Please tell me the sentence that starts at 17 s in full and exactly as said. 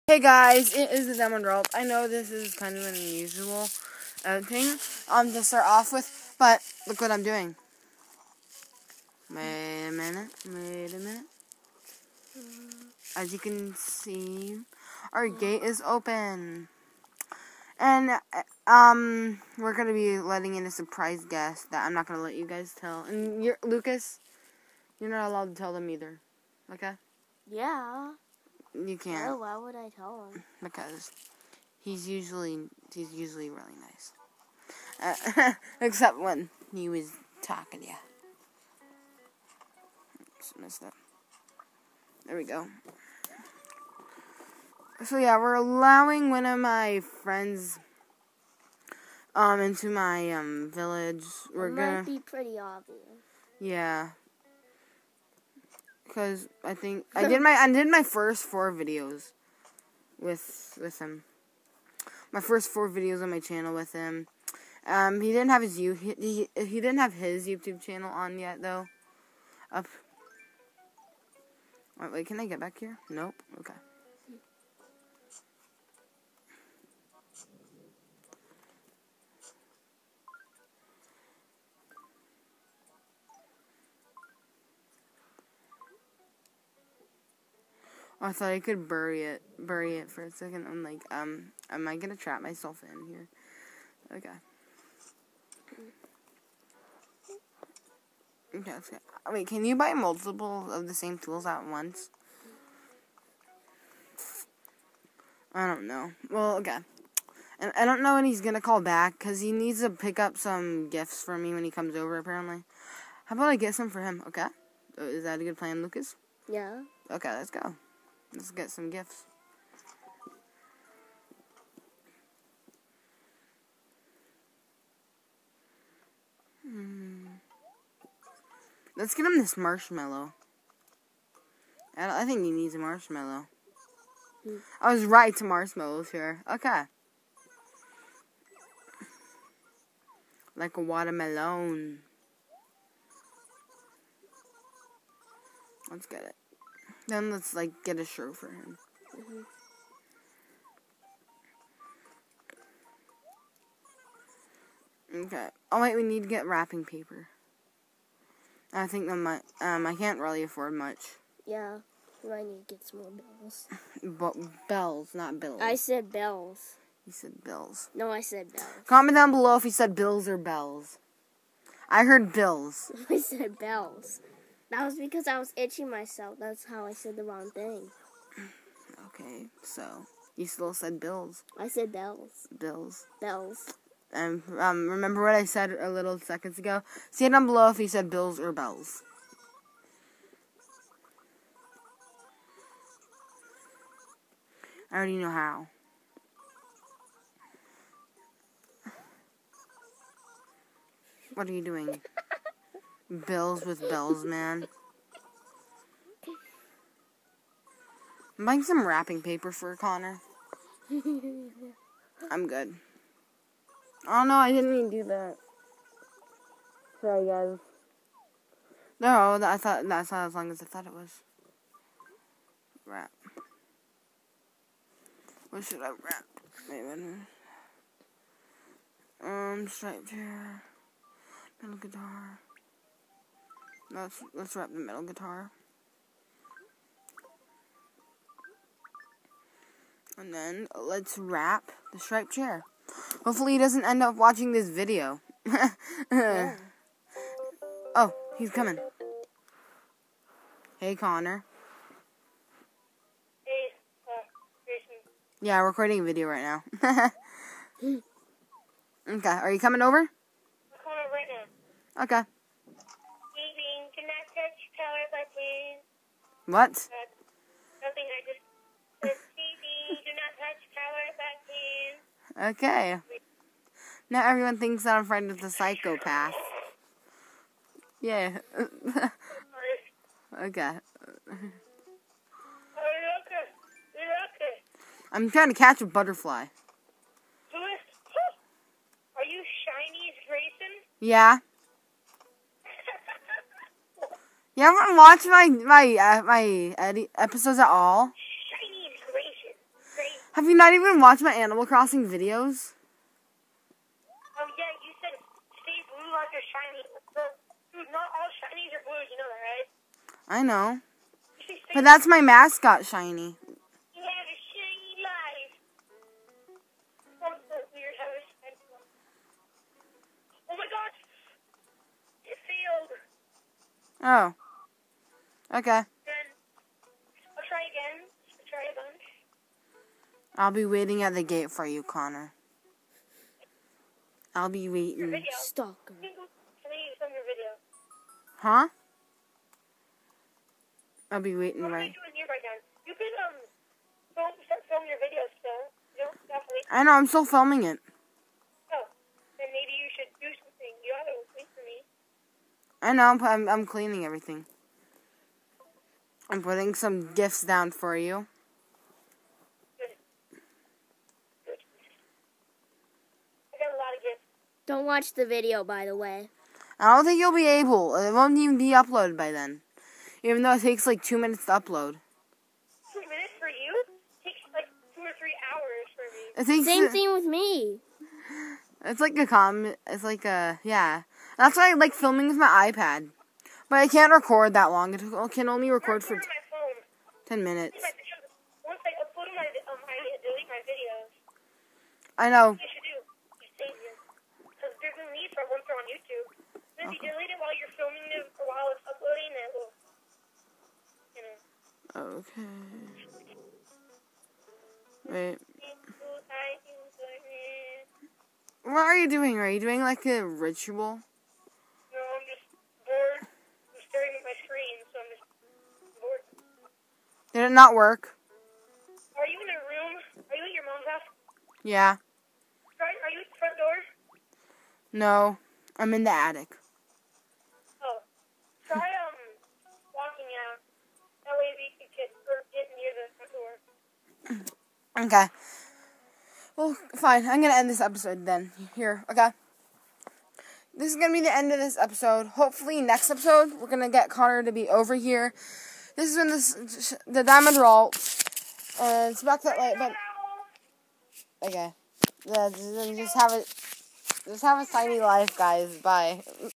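And uh, um, we're going to be letting in a surprise guest that I'm not going to let you guys tell.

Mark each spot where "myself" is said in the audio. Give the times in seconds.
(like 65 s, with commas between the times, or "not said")
92 s, 175 s.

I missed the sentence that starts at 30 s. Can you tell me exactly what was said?
Because he's usually he's usually really nice.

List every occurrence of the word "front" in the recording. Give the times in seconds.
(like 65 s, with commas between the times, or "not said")
423 s, 435 s.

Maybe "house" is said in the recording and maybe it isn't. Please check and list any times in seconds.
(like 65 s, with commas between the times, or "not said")
420 s.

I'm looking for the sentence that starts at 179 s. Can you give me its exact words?
Okay, so you still said bills.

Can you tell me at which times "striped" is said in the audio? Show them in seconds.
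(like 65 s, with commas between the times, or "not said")
229 s, 241 s.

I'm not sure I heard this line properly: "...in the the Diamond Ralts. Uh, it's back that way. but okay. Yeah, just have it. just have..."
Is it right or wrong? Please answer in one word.
right.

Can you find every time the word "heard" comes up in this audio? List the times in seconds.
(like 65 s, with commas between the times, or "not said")
172 s.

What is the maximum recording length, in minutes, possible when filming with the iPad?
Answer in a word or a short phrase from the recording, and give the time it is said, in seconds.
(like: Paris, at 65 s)
10 minutes, at 387 s.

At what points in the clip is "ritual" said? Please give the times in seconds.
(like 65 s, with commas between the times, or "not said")
410 s.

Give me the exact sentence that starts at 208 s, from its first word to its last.
I'm buying some wrapping paper for Connor.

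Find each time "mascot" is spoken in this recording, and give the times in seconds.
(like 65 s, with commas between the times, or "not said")
312 s.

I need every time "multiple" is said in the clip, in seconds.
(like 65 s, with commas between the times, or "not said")
99 s.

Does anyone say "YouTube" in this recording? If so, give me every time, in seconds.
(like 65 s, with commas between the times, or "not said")
67 s.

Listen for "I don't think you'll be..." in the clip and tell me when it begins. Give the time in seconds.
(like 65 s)
366 s.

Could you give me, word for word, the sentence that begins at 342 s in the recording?
You can um, film, start filming your video.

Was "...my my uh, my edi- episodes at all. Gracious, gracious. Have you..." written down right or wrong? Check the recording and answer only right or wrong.
right.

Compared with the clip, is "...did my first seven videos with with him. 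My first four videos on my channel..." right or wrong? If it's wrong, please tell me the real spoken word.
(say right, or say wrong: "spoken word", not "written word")
wrong: "four", not "seven".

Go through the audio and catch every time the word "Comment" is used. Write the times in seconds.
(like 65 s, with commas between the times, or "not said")
168 s.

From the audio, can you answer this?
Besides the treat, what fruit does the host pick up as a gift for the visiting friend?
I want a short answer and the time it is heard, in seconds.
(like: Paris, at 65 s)
Watermelon, at 140 s.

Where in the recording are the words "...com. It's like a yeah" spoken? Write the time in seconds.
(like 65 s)
379 s.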